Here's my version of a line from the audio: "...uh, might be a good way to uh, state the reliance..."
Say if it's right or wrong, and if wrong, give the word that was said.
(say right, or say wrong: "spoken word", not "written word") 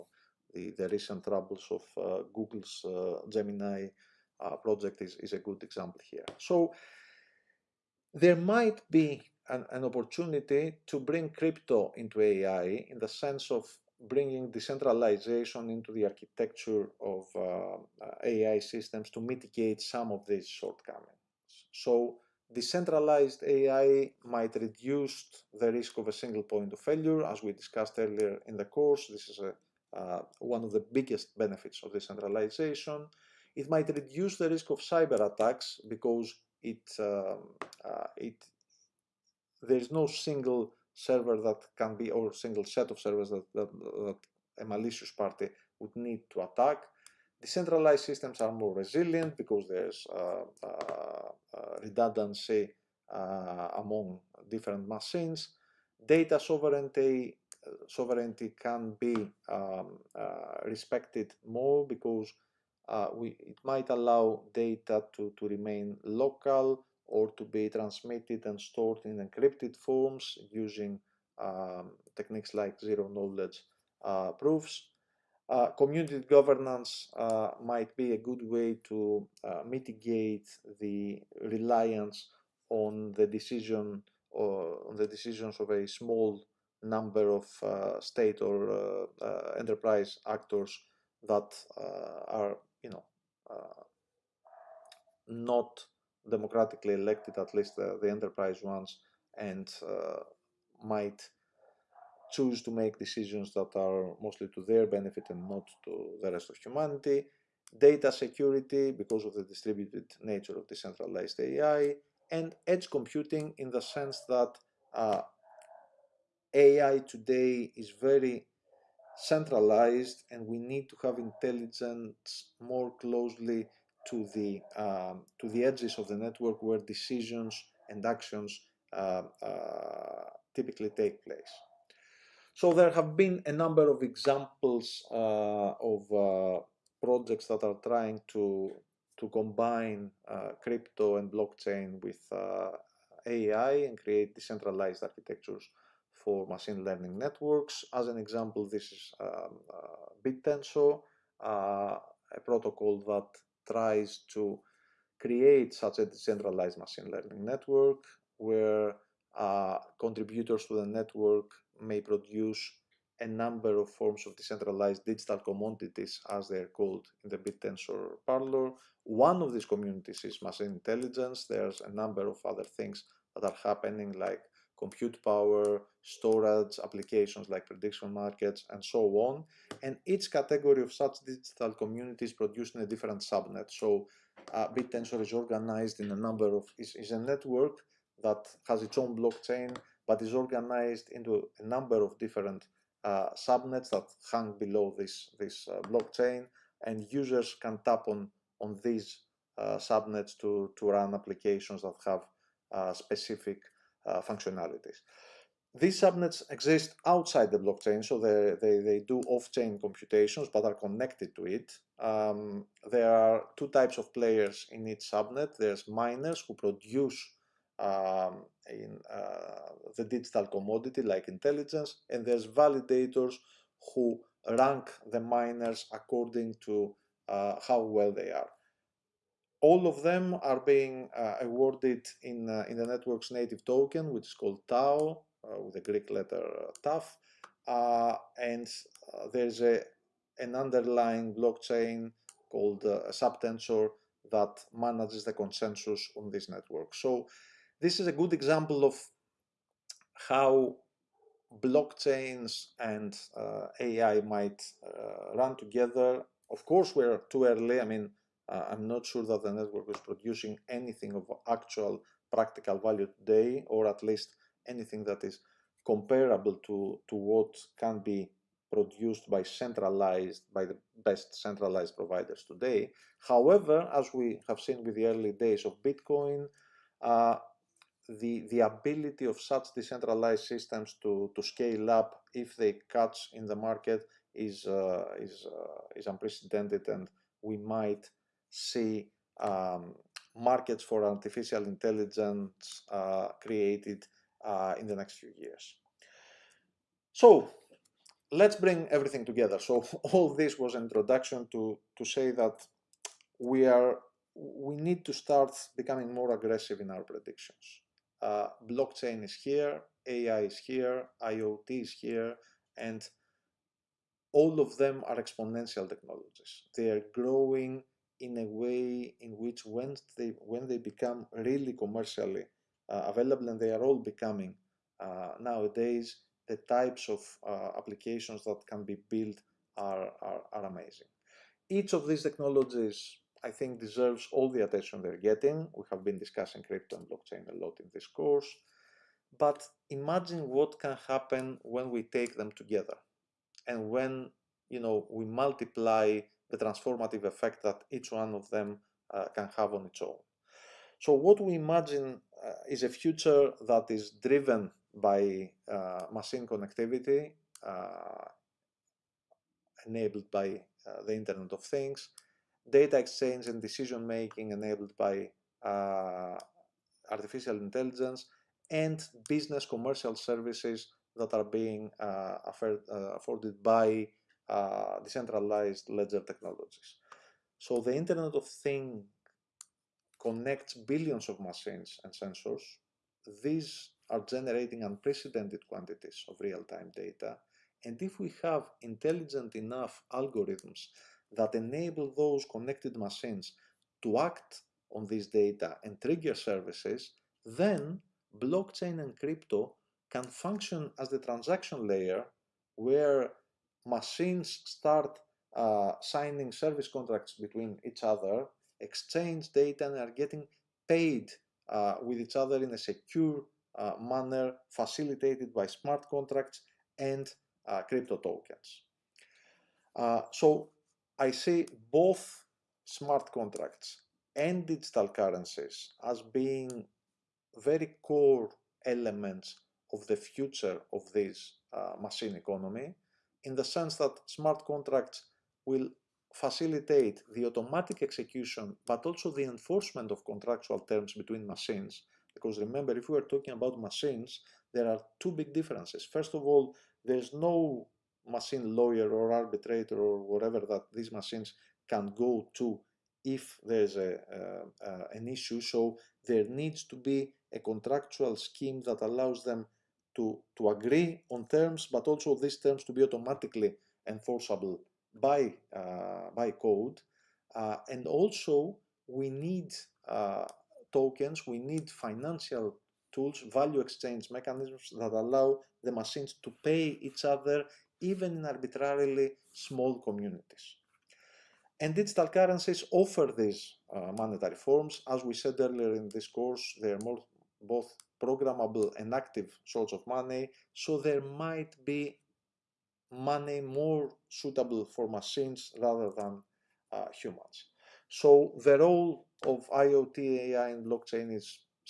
wrong: "mitigate", not "state".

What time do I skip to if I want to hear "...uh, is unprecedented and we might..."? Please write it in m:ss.
4:45.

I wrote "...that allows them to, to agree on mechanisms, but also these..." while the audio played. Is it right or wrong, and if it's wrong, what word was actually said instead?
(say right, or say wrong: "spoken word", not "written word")
wrong: "terms", not "mechanisms".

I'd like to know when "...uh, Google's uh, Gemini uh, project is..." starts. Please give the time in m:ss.
0:01.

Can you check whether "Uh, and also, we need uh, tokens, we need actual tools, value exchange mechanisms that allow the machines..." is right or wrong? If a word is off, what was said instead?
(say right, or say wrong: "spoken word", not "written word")
wrong: "financial", not "actual".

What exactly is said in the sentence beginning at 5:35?
We have been discussing crypto and blockchain a lot in this course.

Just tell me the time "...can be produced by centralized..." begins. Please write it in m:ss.
4:27.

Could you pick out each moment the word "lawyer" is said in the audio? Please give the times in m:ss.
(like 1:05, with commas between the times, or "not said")
7:28.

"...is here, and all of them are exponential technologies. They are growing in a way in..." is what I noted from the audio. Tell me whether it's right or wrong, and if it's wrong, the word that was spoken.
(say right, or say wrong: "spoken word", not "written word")
right.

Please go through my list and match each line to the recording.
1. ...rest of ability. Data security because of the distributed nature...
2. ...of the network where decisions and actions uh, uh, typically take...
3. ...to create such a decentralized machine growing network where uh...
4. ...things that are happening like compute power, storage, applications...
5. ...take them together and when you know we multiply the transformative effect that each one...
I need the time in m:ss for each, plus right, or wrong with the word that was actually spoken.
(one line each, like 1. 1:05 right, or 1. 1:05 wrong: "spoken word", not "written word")
1. 1:46 wrong: "humanity", not "ability"
2. 2:05 right
3. 2:34 wrong: "learning", not "growing"
4. 2:52 right
5. 5:42 right.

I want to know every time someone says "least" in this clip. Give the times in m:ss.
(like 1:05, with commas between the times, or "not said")
1:37, 4:24.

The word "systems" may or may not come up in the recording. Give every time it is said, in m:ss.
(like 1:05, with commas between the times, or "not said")
0:18, 0:48, 4:40.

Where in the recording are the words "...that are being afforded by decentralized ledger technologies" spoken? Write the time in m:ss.
6:11.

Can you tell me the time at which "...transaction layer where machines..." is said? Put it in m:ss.
6:41.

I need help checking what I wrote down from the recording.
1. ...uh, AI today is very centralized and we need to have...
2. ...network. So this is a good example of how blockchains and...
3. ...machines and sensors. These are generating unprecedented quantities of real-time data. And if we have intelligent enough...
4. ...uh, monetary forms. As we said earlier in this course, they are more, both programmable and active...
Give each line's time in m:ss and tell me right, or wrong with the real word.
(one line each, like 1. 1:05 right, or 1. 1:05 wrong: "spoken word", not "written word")
1. 1:54 right
2. 4:06 right
3. 6:21 right
4. 8:03 right.